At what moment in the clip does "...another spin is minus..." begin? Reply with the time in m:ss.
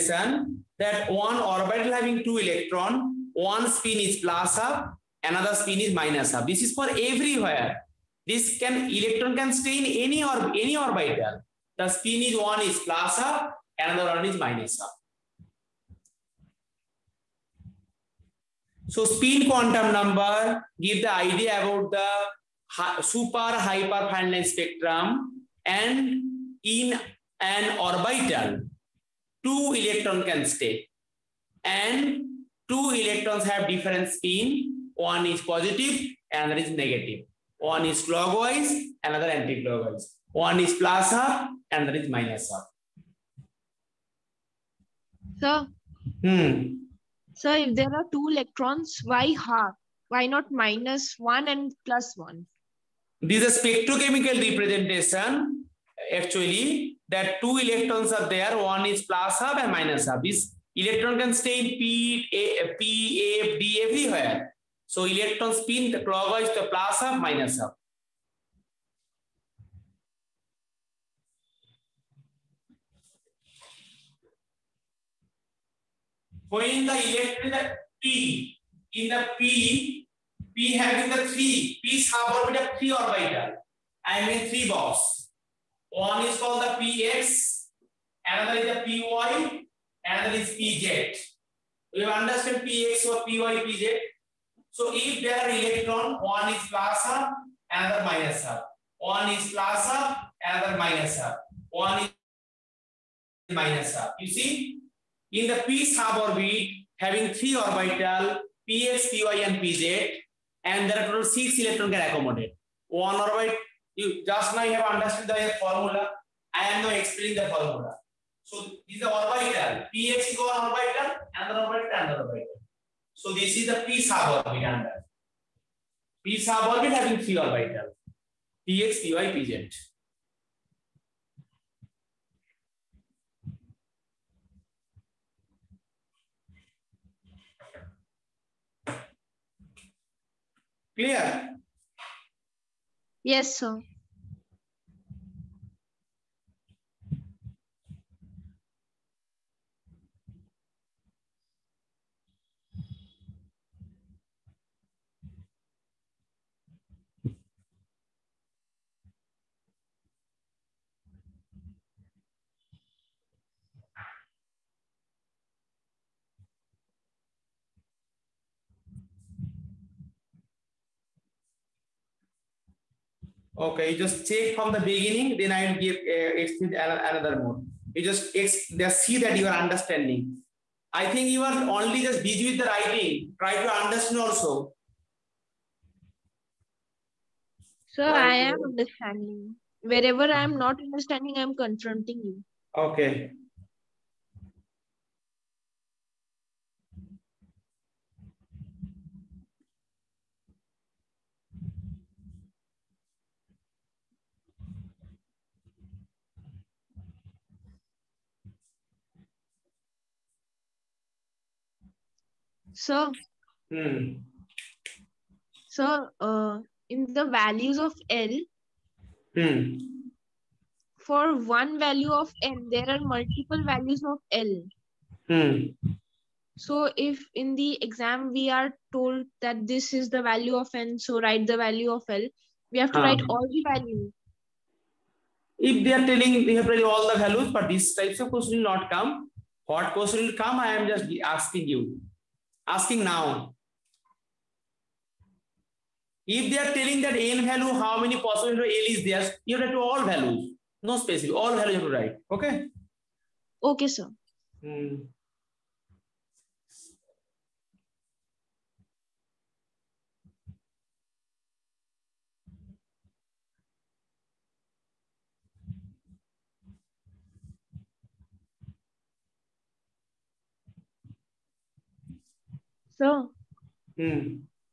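0:05.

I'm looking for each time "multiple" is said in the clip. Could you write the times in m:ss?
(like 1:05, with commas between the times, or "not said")
3:43.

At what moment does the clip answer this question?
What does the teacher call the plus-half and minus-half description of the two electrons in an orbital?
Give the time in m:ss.
0:53.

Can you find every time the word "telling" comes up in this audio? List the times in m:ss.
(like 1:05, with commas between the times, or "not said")
3:56, 4:06.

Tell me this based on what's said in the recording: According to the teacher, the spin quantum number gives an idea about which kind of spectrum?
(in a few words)
Super hyper fine line spectrum.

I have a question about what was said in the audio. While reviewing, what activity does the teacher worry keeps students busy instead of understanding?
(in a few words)
Writing.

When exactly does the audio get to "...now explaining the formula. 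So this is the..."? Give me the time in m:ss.
1:56.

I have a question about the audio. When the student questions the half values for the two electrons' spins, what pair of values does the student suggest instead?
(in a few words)
Minus one and plus one.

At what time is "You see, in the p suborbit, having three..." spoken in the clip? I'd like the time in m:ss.
1:44.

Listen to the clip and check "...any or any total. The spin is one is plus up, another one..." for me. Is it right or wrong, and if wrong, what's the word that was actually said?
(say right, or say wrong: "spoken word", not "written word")
wrong: "orbital", not "total".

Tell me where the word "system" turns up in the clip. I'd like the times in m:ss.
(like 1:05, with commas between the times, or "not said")
not said.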